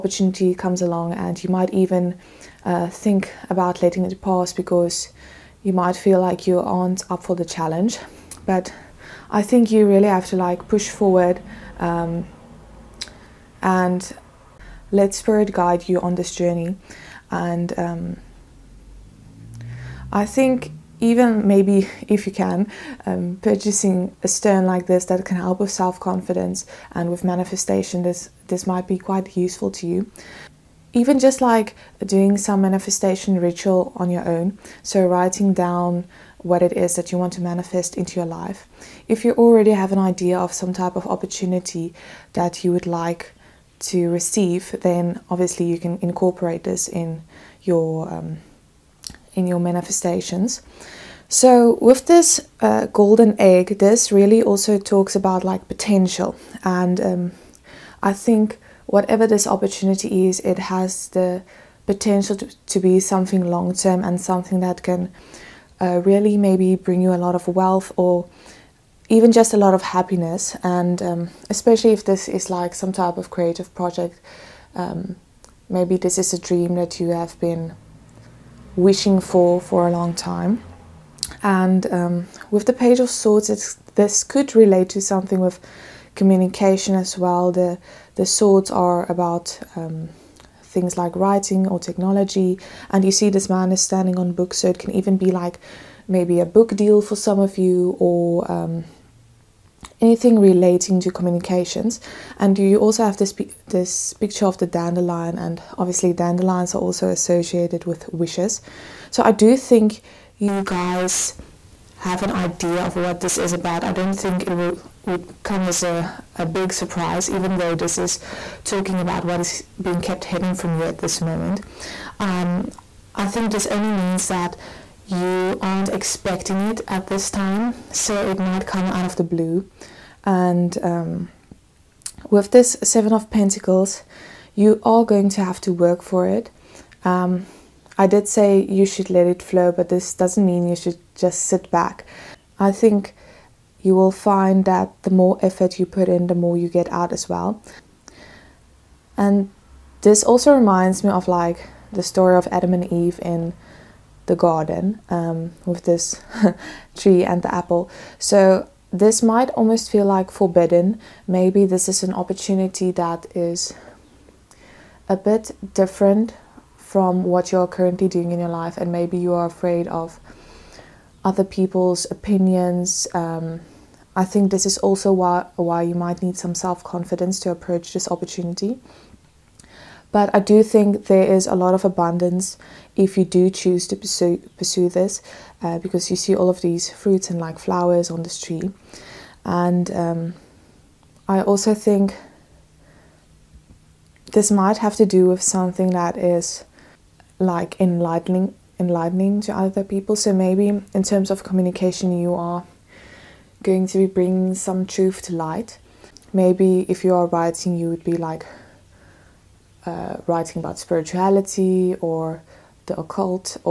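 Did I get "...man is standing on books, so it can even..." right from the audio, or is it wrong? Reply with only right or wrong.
right.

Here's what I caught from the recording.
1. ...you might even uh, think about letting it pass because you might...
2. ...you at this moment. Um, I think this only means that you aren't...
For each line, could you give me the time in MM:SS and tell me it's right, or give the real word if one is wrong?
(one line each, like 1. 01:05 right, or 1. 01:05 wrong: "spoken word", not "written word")
1. 00:01 right
2. 02:00 right.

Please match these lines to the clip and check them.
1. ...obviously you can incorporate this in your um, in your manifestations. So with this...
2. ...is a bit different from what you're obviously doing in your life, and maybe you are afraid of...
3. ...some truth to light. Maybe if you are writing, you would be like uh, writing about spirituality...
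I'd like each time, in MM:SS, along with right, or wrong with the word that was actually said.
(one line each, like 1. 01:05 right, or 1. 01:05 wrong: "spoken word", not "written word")
1. 00:45 right
2. 02:43 wrong: "currently", not "obviously"
3. 03:24 right.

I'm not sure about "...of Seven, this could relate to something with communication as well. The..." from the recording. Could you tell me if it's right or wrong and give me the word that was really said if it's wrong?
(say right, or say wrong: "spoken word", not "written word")
wrong: "Swords", not "Seven".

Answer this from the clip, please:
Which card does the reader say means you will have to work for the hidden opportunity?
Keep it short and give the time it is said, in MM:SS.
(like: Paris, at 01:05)
Seven of Pentacles, at 02:12.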